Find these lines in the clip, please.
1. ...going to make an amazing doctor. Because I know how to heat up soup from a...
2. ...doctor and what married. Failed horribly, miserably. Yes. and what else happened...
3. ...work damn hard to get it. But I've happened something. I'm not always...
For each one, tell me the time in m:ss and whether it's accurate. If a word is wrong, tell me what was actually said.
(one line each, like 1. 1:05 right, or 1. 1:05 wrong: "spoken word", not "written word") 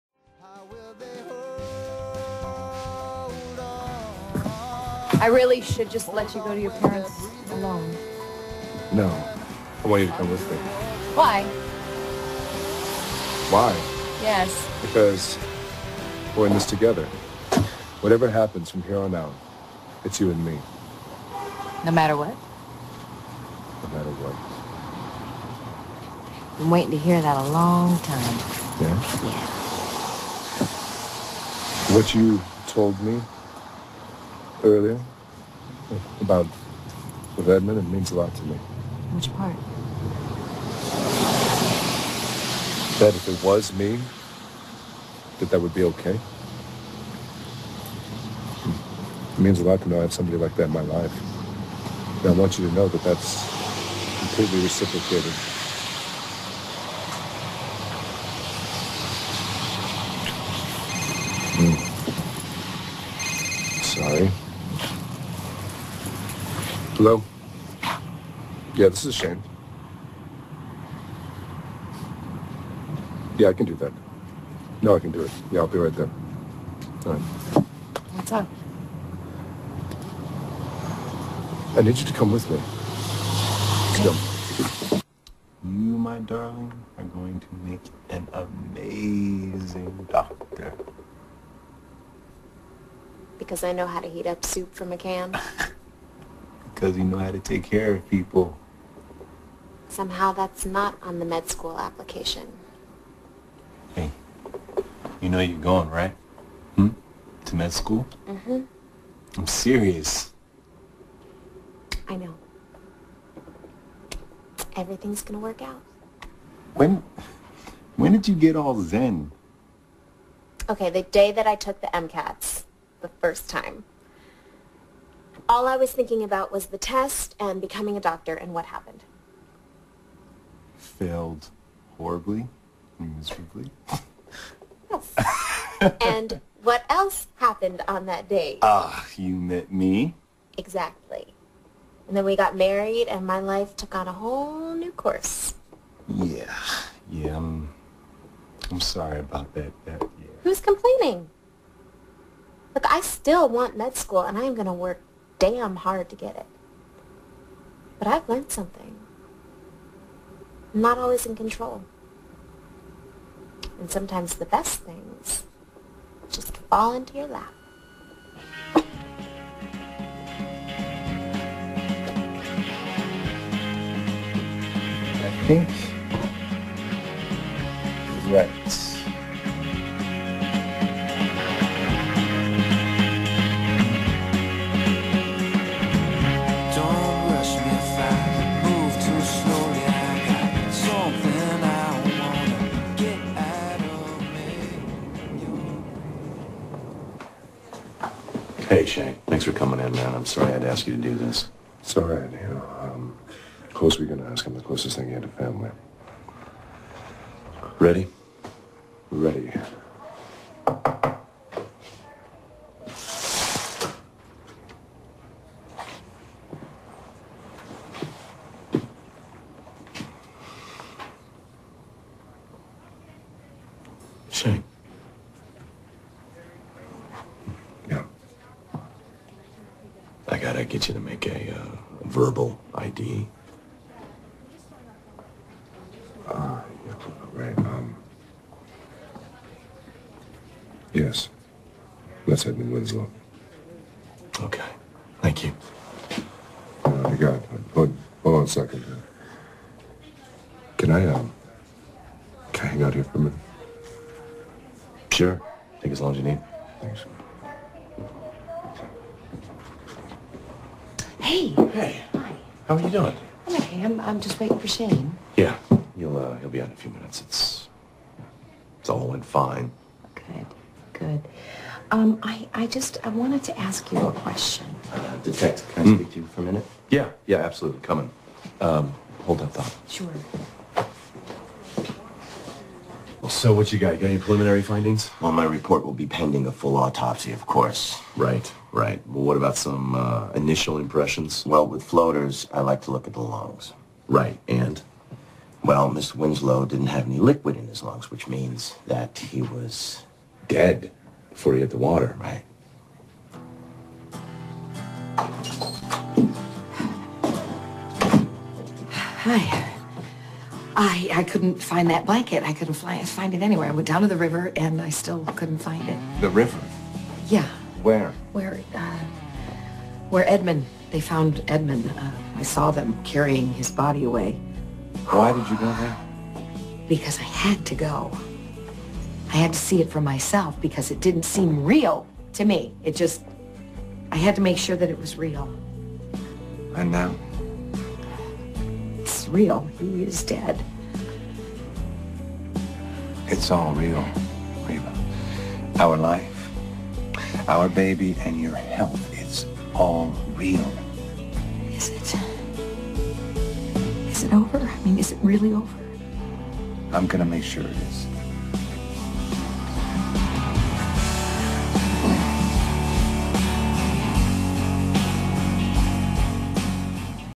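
1. 1:27 right
2. 2:07 wrong: "happened", not "married"
3. 2:34 wrong: "learned", not "happened".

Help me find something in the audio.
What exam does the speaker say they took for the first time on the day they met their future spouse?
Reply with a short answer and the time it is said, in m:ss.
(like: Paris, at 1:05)
MCATs, at 2:01.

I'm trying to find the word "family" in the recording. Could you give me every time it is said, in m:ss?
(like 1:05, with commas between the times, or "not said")
3:25.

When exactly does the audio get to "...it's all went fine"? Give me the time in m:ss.
4:28.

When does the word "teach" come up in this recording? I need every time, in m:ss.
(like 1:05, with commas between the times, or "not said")
not said.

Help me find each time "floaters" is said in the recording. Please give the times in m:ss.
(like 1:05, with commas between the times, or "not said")
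4:51.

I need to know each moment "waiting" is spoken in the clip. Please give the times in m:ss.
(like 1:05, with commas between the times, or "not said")
0:26, 4:24.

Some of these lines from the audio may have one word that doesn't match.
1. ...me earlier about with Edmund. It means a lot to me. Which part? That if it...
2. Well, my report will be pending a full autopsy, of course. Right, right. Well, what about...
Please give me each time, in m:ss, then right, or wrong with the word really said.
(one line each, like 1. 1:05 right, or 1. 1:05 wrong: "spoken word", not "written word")
1. 0:33 right
2. 4:45 right.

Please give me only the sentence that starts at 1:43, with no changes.
Hey, you know you're going, right?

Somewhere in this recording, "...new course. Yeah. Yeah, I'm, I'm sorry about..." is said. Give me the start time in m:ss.
2:24.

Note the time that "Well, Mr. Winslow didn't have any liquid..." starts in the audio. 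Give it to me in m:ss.
4:55.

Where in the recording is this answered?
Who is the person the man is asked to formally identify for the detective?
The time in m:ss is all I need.
4:02.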